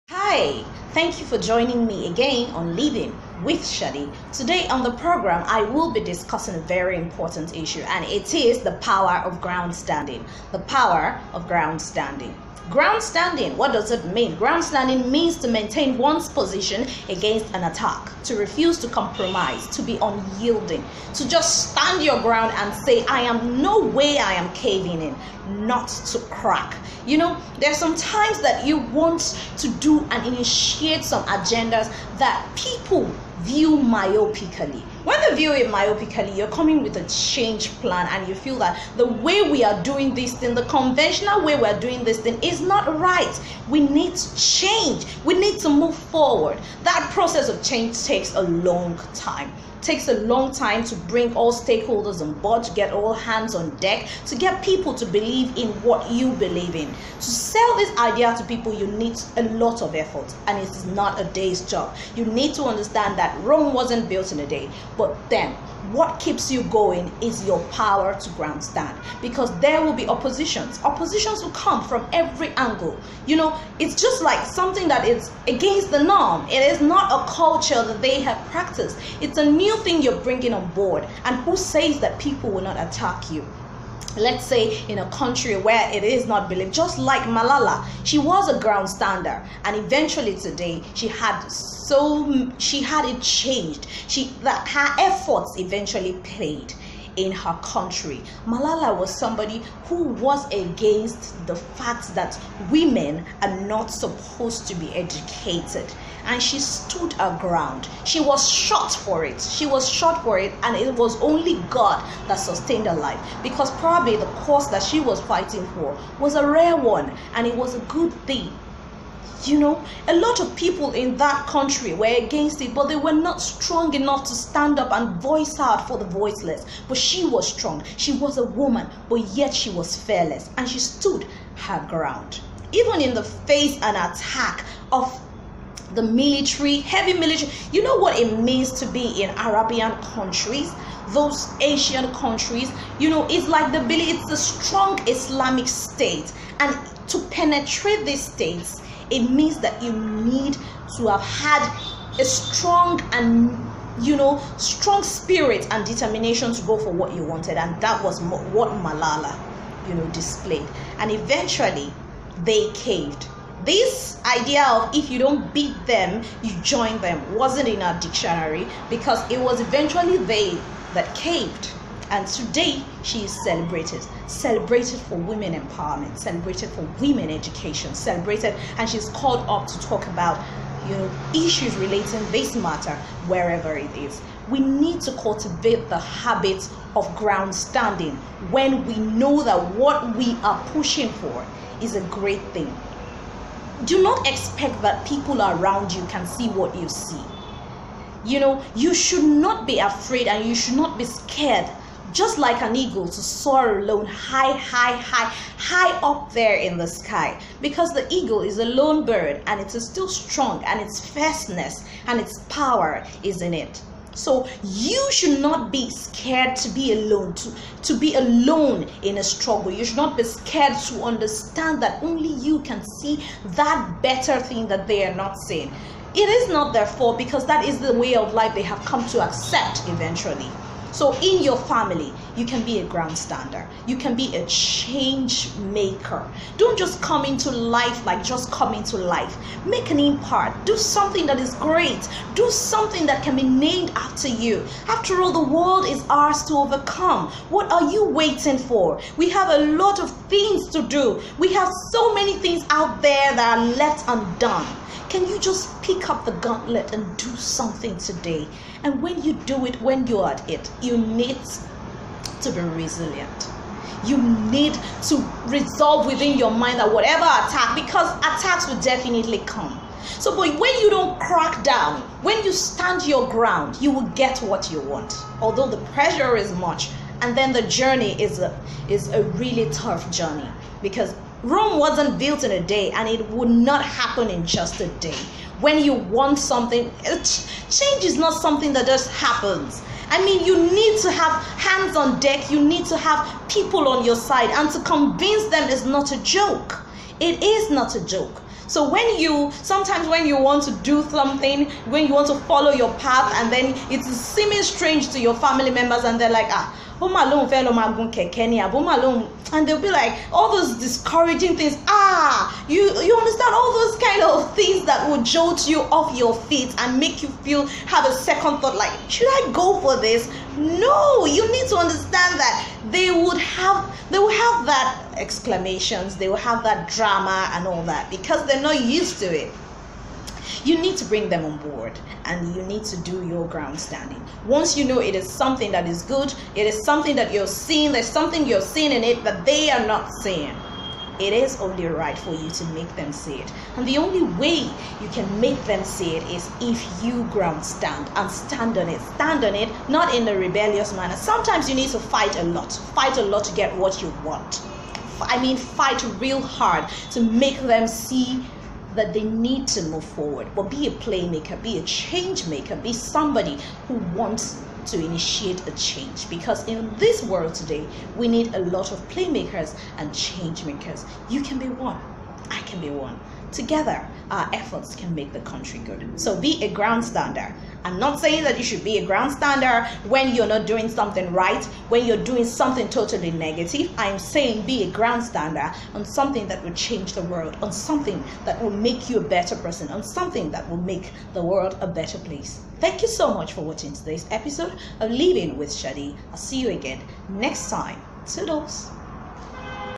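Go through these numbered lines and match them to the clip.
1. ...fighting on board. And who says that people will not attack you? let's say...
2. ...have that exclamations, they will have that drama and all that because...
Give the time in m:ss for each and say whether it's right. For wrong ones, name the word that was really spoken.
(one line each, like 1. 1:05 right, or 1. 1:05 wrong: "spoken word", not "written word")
1. 1:20 wrong: "bringing", not "fighting"
2. 5:24 right.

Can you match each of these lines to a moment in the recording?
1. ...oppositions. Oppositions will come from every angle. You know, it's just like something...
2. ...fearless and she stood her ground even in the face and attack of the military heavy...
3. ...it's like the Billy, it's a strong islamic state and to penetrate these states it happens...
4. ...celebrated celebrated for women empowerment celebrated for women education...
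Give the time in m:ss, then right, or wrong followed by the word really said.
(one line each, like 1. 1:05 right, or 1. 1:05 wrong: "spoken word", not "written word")
1. 1:10 right
2. 2:09 right
3. 2:23 wrong: "means", not "happens"
4. 2:53 right.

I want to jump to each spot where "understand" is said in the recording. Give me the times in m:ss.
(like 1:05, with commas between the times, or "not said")
1:02, 3:41, 5:13, 5:21.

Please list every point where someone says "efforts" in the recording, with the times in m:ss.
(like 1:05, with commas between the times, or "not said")
0:59, 1:34, 6:14.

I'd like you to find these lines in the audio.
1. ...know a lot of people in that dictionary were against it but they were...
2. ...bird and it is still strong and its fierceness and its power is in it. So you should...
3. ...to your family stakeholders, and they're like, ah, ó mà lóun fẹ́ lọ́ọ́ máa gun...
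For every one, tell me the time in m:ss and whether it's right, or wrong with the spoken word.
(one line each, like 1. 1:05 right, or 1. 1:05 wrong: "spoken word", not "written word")
1. 1:59 wrong: "country", not "dictionary"
2. 3:29 right
3. 5:05 wrong: "members", not "stakeholders".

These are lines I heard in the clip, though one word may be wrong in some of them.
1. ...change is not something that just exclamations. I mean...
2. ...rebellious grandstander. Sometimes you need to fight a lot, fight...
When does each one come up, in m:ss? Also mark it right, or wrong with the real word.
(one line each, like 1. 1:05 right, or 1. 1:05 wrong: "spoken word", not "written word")
1. 4:47 wrong: "happens", not "exclamations"
2. 5:50 wrong: "manner", not "grandstander".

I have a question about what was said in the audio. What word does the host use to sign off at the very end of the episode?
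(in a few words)
Toodles.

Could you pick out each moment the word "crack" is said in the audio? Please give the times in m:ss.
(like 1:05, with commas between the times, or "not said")
0:26, 4:31.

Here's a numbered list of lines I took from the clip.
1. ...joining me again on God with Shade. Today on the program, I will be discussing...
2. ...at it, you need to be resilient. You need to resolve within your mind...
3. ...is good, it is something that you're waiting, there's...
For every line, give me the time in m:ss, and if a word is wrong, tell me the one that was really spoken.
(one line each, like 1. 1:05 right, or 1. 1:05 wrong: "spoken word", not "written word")
1. 0:01 wrong: "Living", not "God"
2. 4:20 right
3. 5:35 wrong: "seeing", not "waiting".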